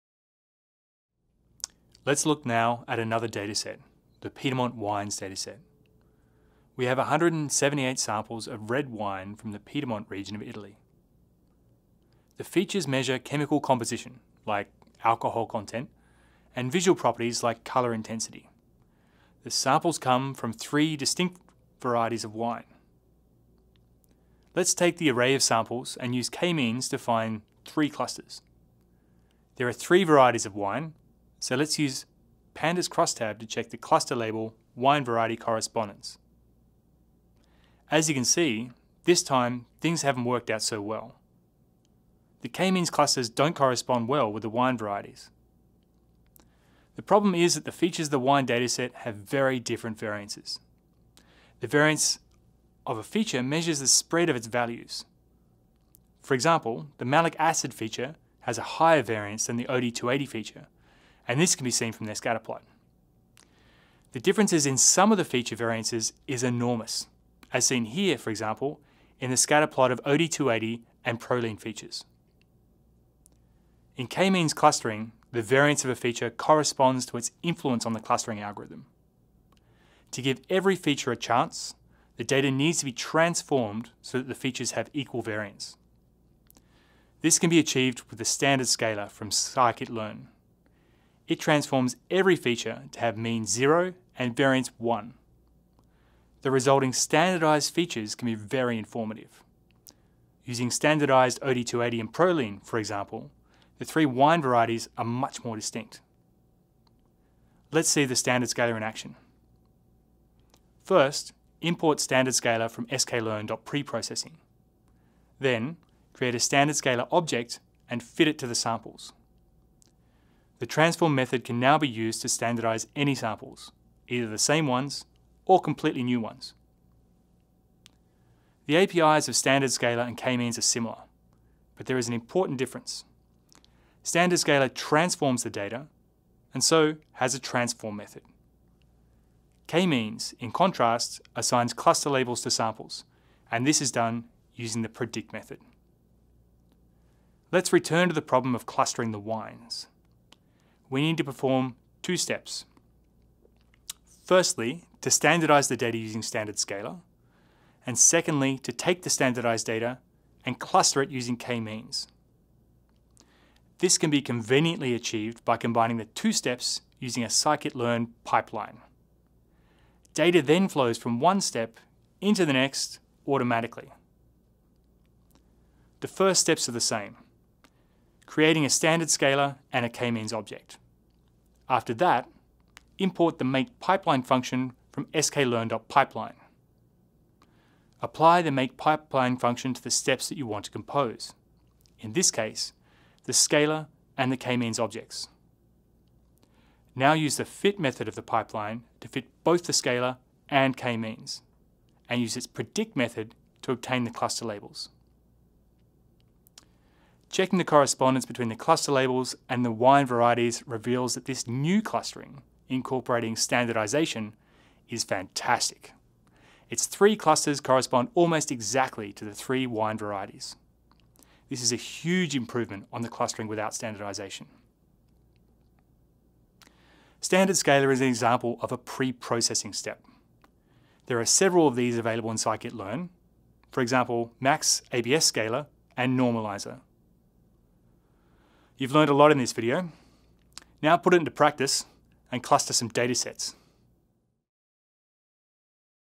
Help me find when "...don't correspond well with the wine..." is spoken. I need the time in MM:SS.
00:43.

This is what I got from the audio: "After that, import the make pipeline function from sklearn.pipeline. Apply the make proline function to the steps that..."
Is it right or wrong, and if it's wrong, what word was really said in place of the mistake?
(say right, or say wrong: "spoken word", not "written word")
wrong: "pipeline", not "proline".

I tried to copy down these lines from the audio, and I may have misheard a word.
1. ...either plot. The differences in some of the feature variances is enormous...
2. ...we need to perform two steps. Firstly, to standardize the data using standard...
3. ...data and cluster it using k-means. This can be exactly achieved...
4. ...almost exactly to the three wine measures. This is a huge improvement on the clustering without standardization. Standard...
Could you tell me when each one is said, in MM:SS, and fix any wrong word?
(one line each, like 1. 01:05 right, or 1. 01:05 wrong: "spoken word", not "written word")
1. 01:02 wrong: "scatter", not "either"
2. 02:30 right
3. 02:39 wrong: "conveniently", not "exactly"
4. 03:38 wrong: "varieties", not "measures".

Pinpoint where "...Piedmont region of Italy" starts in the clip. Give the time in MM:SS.
00:09.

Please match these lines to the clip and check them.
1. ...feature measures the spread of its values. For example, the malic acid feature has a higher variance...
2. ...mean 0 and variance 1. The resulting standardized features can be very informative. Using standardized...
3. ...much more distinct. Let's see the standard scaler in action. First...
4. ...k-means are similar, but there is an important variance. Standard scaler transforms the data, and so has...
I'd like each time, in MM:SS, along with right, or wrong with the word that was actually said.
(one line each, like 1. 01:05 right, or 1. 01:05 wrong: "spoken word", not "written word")
1. 00:53 right
2. 01:33 right
3. 01:45 right
4. 02:10 wrong: "difference", not "variance".